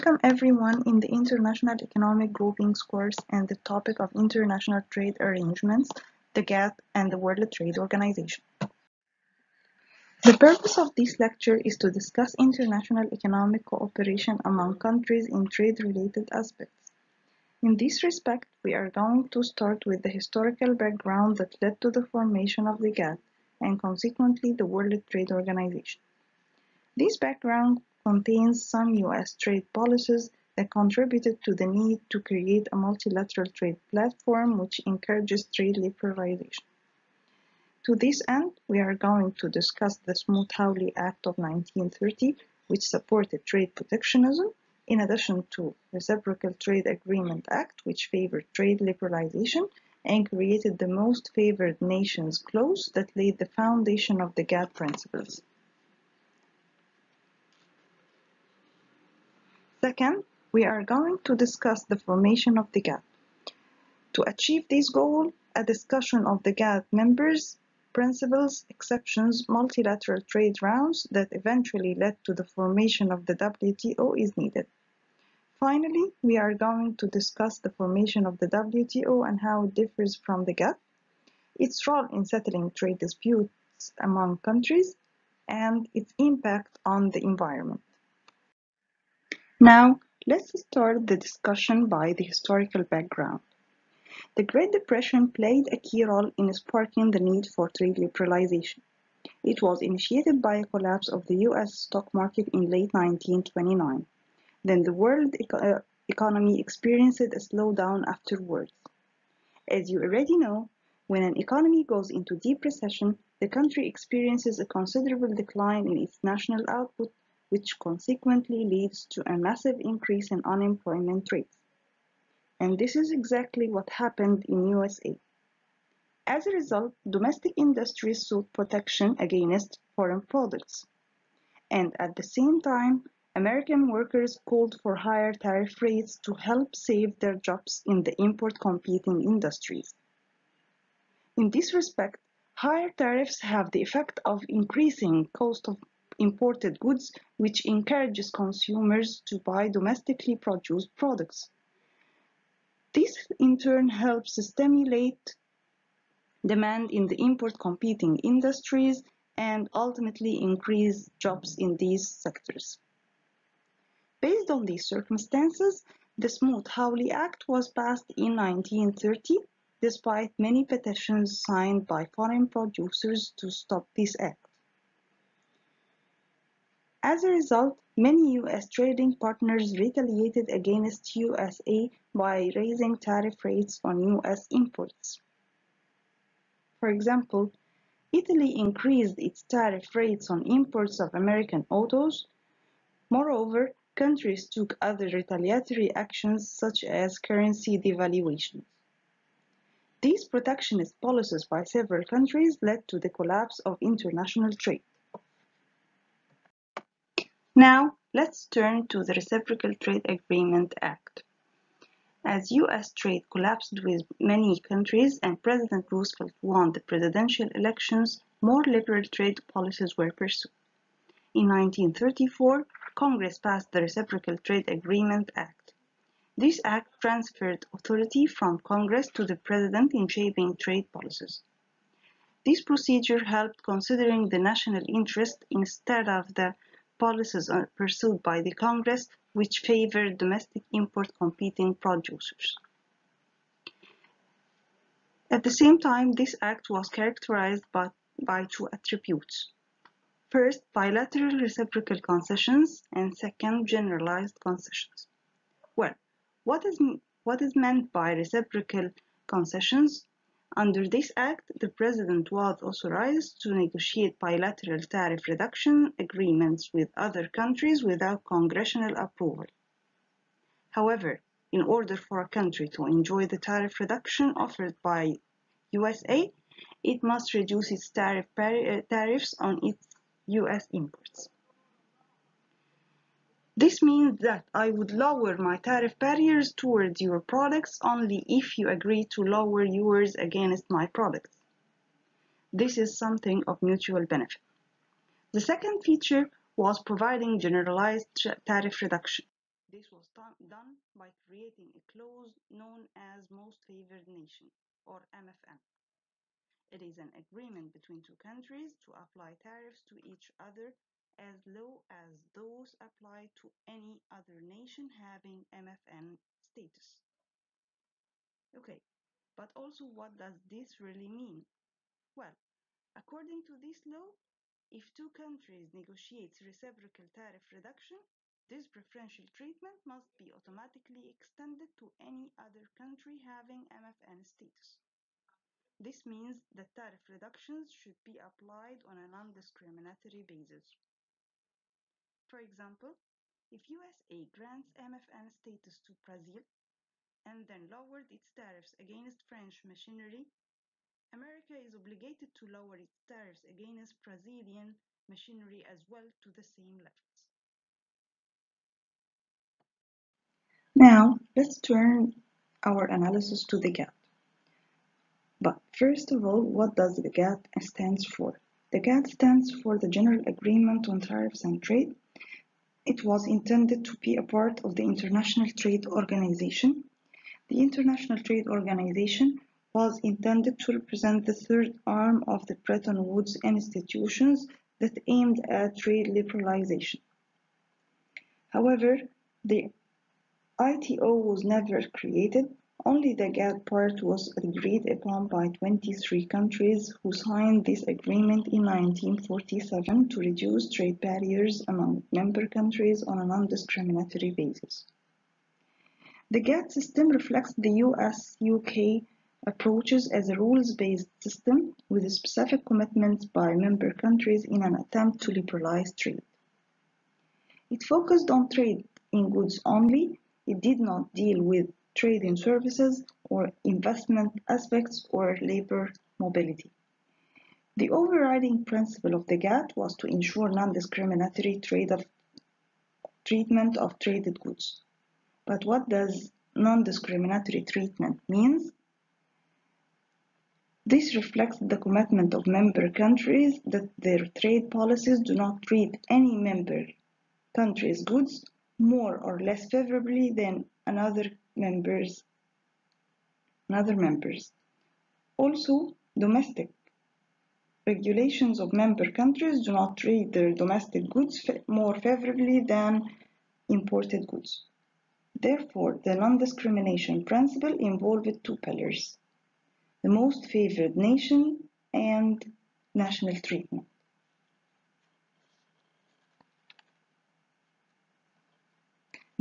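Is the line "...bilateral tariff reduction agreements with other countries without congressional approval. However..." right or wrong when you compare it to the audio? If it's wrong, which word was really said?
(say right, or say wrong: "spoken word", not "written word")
right.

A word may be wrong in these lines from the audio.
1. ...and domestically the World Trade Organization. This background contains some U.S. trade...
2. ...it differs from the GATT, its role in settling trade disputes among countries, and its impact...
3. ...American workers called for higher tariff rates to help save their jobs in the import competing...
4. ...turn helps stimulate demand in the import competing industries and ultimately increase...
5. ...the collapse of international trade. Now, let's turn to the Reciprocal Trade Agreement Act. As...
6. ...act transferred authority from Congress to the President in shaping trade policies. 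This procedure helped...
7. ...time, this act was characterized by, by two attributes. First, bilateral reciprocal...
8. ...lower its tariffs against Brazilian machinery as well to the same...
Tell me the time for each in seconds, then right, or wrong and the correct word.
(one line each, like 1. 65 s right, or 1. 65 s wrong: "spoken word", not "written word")
1. 23 s wrong: "consequently", not "domestically"
2. 79 s right
3. 133 s right
4. 153 s right
5. 202 s right
6. 226 s right
7. 245 s right
8. 352 s right.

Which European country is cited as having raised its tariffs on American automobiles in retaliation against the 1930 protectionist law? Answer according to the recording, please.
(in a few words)
Italy.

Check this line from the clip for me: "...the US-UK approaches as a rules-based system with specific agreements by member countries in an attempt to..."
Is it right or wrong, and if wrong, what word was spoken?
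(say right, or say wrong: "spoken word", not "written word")
wrong: "commitments", not "agreements".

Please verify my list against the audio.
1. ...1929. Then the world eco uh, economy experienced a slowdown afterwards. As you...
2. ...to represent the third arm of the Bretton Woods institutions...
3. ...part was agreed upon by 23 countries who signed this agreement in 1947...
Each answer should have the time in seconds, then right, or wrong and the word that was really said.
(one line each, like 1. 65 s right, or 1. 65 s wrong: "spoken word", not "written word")
1. 102 s right
2. 380 s right
3. 393 s right.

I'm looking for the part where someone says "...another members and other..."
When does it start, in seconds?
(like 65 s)
450 s.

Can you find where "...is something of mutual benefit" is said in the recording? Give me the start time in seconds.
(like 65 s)
292 s.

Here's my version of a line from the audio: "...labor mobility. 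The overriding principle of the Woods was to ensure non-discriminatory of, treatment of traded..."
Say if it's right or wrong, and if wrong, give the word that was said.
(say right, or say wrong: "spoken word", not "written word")
wrong: "GATT", not "Woods".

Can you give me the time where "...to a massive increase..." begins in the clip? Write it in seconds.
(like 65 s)
119 s.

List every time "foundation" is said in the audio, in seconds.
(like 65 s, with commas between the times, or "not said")
53 s.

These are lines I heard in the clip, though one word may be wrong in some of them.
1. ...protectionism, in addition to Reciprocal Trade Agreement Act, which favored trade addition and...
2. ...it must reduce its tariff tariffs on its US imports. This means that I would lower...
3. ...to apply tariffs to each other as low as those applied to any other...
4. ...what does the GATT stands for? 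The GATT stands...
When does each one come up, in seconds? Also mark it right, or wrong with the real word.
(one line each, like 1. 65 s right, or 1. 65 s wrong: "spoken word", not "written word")
1. 43 s wrong: "liberalization", not "addition"
2. 276 s right
3. 308 s right
4. 366 s right.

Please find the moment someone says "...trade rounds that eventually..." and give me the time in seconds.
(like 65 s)
70 s.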